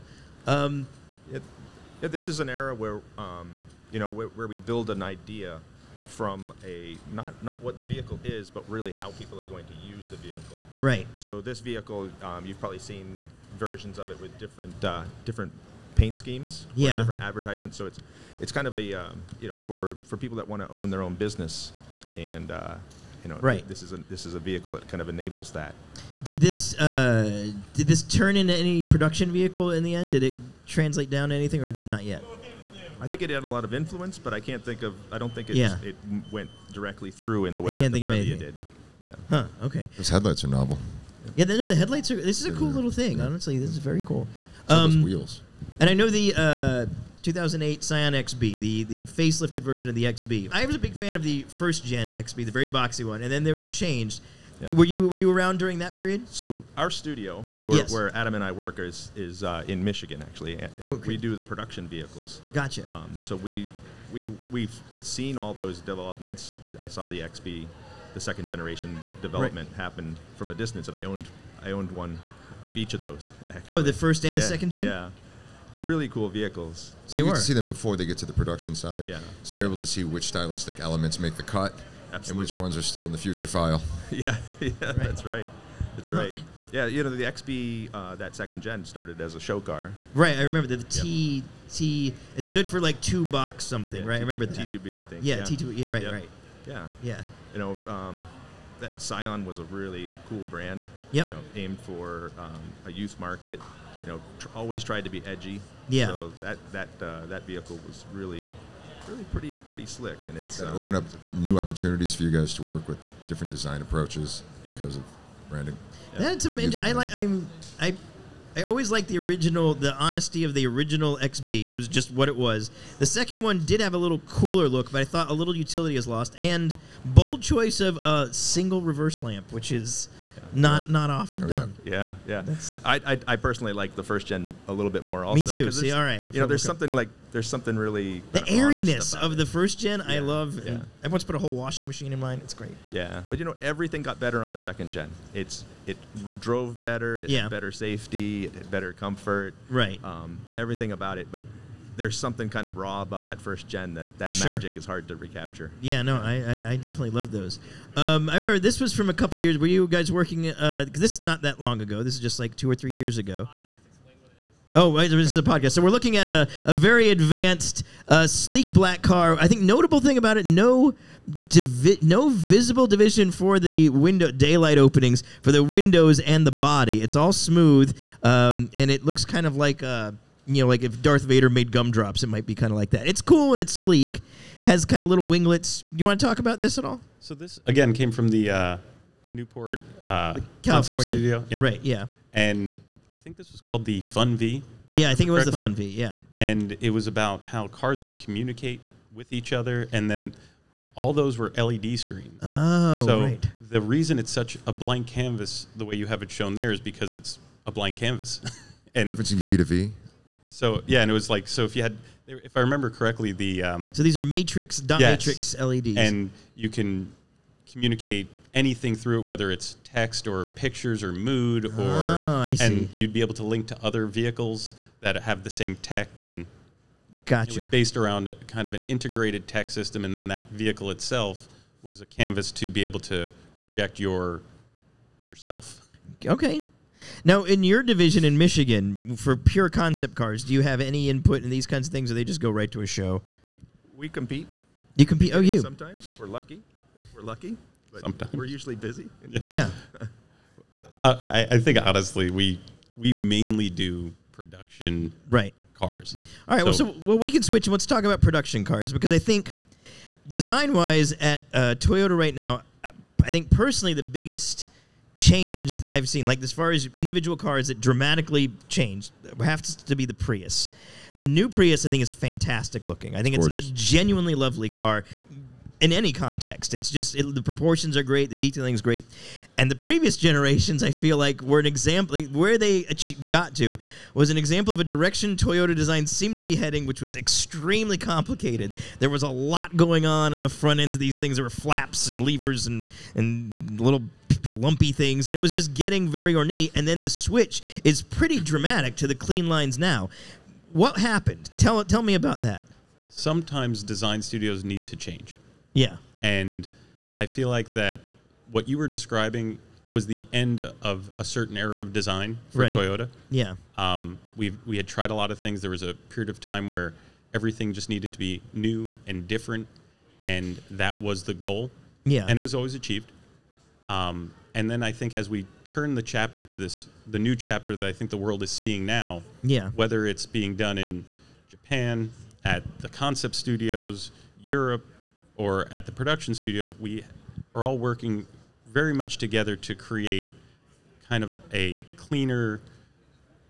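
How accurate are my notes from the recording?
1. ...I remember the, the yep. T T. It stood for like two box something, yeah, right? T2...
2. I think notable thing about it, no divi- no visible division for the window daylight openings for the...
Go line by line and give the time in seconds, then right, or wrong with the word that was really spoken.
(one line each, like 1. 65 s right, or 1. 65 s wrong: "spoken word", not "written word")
1. 90 s right
2. 169 s right.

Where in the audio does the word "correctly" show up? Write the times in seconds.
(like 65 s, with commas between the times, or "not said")
195 s, 212 s.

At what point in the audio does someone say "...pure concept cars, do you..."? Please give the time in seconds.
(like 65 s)
239 s.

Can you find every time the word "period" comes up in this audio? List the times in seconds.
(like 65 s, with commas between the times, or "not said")
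55 s, 315 s.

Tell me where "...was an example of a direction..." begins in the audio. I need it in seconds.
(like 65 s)
284 s.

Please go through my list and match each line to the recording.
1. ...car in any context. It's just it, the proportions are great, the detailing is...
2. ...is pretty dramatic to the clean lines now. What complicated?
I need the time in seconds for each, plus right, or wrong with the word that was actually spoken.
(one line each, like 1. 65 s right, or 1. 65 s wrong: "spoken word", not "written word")
1. 274 s right
2. 297 s wrong: "happened", not "complicated".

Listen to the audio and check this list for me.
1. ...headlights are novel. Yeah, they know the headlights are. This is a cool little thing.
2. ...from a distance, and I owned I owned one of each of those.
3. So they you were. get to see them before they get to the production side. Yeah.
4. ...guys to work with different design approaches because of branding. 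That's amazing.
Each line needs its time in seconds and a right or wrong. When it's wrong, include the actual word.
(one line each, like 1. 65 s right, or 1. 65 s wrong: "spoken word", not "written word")
1. 40 s right
2. 70 s right
3. 77 s right
4. 112 s right.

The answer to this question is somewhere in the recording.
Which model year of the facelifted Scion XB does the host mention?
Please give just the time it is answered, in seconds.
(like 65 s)
47 s.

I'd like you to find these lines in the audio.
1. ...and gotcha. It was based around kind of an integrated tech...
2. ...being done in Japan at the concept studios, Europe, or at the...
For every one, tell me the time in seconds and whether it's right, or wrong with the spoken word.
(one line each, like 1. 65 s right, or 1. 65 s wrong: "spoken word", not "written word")
1. 226 s right
2. 330 s right.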